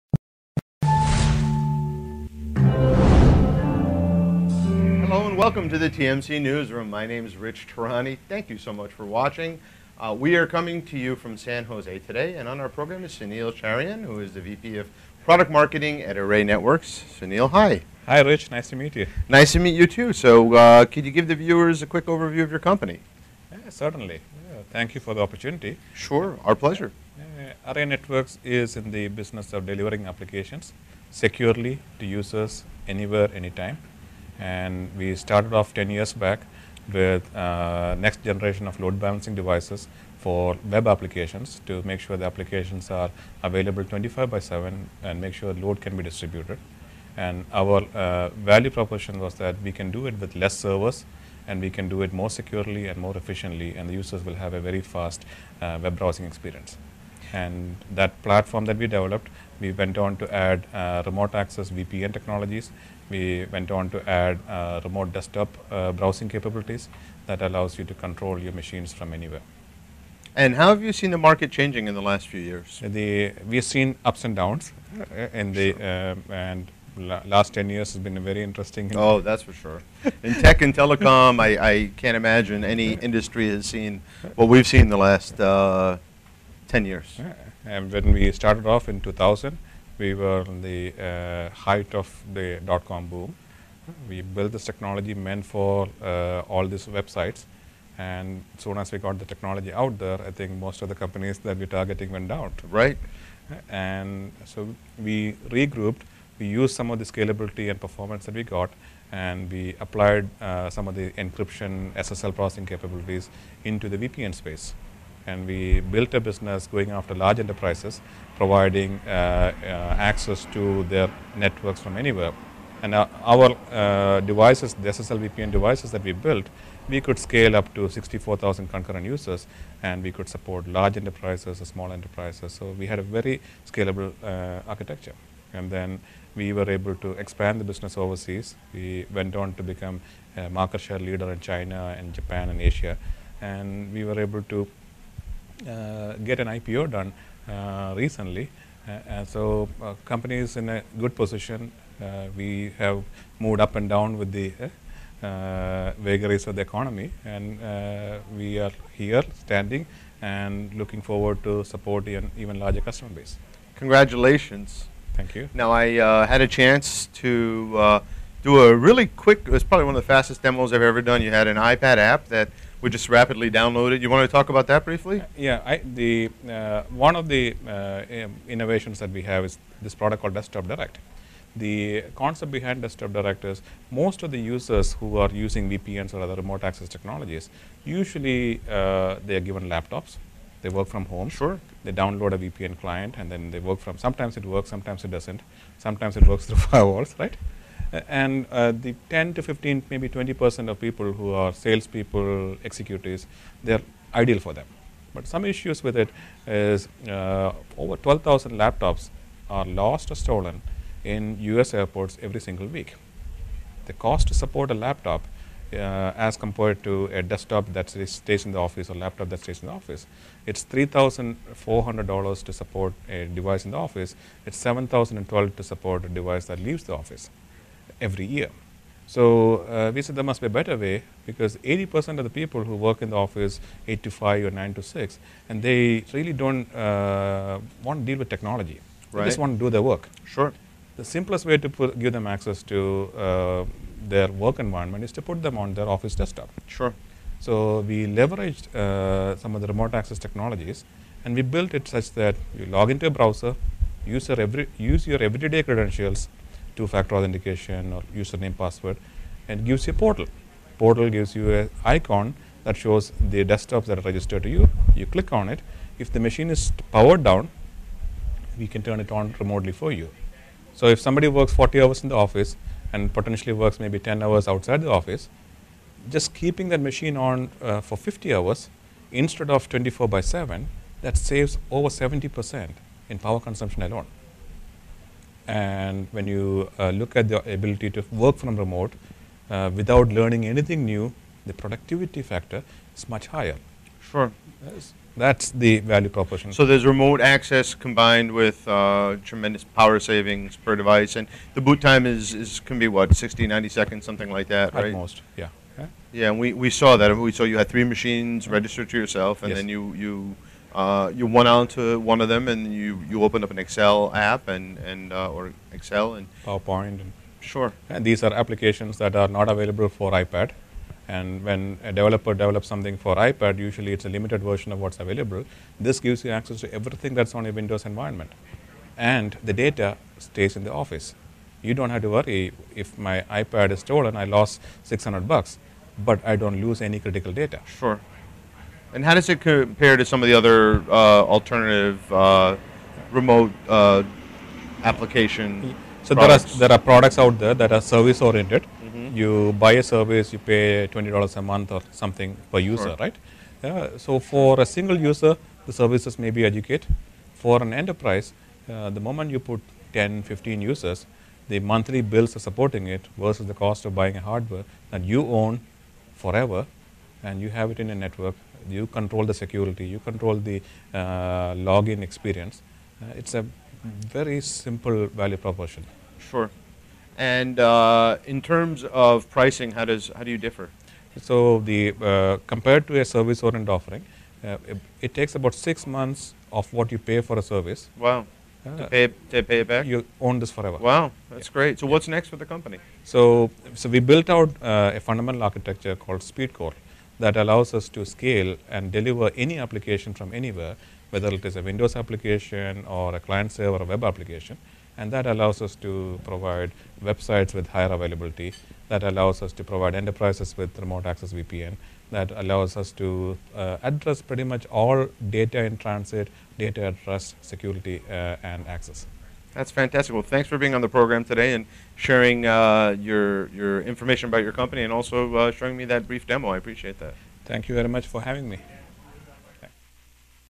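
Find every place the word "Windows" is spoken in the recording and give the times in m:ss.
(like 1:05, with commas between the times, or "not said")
5:27, 6:41.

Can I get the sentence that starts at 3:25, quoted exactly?
But some issues with it is uh, over 12,000 laptops are lost or stolen in US airports every single week.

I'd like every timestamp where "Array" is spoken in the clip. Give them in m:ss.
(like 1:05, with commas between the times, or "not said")
0:16, 0:27.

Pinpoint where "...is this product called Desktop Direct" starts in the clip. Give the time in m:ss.
2:59.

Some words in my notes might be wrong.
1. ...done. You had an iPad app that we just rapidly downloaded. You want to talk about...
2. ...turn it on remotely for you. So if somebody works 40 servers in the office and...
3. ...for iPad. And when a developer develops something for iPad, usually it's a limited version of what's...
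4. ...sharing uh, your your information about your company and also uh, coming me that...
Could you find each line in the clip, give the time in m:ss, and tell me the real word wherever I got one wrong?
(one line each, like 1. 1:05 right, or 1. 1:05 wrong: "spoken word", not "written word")
1. 2:51 right
2. 4:28 wrong: "hours", not "servers"
3. 5:19 right
4. 7:01 wrong: "showing", not "coming".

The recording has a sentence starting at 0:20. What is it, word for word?
So uh, could you give the viewers a quick overview of your company?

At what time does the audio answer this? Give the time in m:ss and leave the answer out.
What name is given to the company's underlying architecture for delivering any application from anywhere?
6:36.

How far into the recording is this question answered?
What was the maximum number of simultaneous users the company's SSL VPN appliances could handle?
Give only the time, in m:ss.
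2:07.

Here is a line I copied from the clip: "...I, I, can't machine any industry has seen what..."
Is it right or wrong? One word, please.
wrong.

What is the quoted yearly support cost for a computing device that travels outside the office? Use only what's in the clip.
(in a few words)
$7,012.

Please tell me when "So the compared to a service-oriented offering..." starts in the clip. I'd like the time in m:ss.
6:21.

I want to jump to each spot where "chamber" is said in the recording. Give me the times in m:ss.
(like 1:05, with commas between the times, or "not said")
not said.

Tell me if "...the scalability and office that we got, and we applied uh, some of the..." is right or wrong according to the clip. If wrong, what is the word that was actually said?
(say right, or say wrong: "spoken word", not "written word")
wrong: "performance", not "office".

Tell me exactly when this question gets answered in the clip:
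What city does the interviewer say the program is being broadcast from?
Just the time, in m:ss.
0:11.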